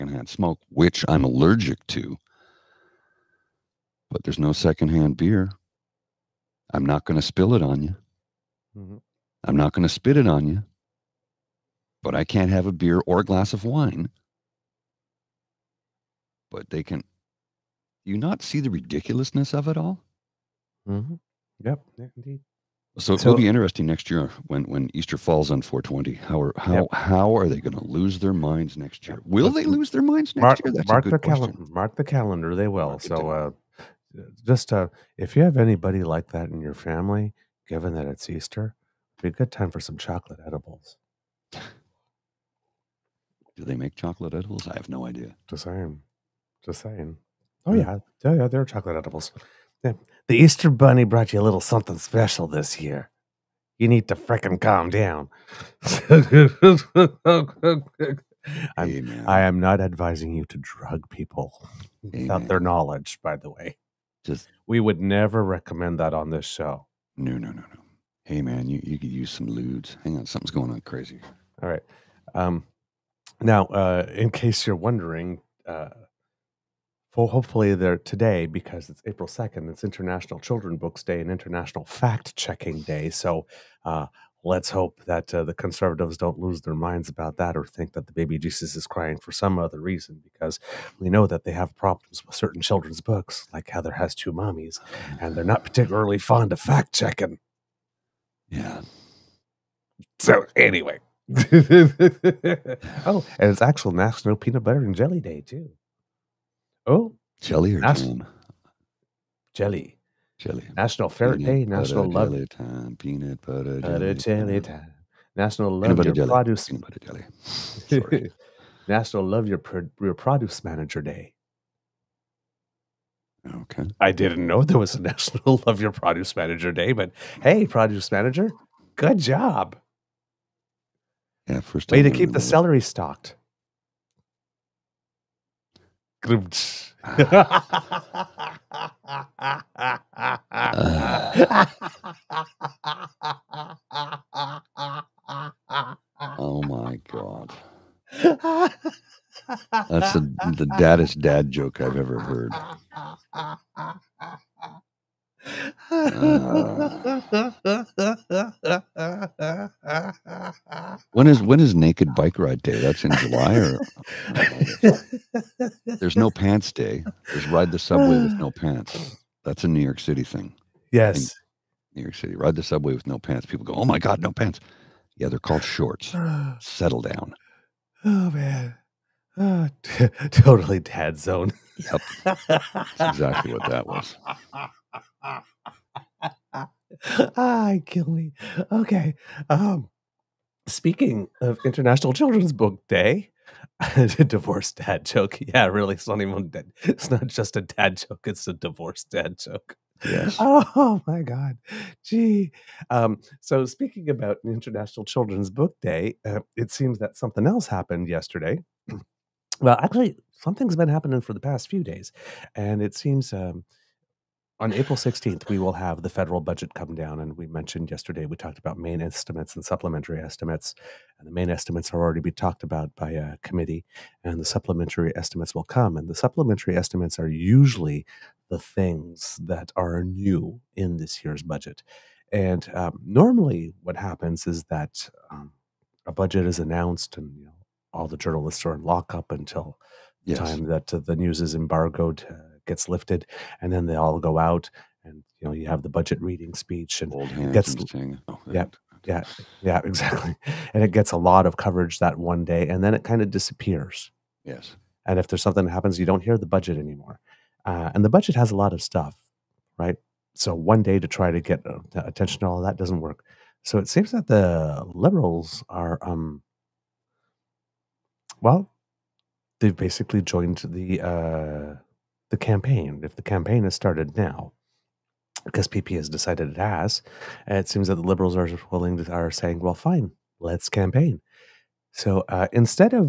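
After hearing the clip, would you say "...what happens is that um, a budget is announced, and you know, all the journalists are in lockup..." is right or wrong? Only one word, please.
right.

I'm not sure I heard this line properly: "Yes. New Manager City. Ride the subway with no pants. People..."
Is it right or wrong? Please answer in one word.
wrong.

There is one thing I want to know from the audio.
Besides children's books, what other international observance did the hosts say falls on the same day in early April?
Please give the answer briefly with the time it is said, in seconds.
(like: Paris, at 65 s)
International Fact Checking Day, at 81 s.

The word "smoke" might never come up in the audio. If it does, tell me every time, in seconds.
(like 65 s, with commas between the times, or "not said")
0 s.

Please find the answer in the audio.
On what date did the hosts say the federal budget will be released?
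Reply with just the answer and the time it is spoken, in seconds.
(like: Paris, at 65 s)
April 16, at 214 s.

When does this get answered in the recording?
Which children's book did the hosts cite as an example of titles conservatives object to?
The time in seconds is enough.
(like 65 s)
93 s.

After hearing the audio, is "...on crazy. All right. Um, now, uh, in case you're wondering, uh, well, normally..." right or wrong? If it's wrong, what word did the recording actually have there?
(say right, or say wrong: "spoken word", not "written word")
wrong: "hopefully", not "normally".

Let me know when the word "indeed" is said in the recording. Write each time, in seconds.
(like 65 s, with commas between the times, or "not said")
22 s.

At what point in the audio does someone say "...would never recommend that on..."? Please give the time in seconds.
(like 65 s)
64 s.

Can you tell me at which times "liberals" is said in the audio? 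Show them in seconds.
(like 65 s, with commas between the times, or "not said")
264 s, 278 s.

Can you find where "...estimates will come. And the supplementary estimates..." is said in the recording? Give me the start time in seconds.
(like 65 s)
225 s.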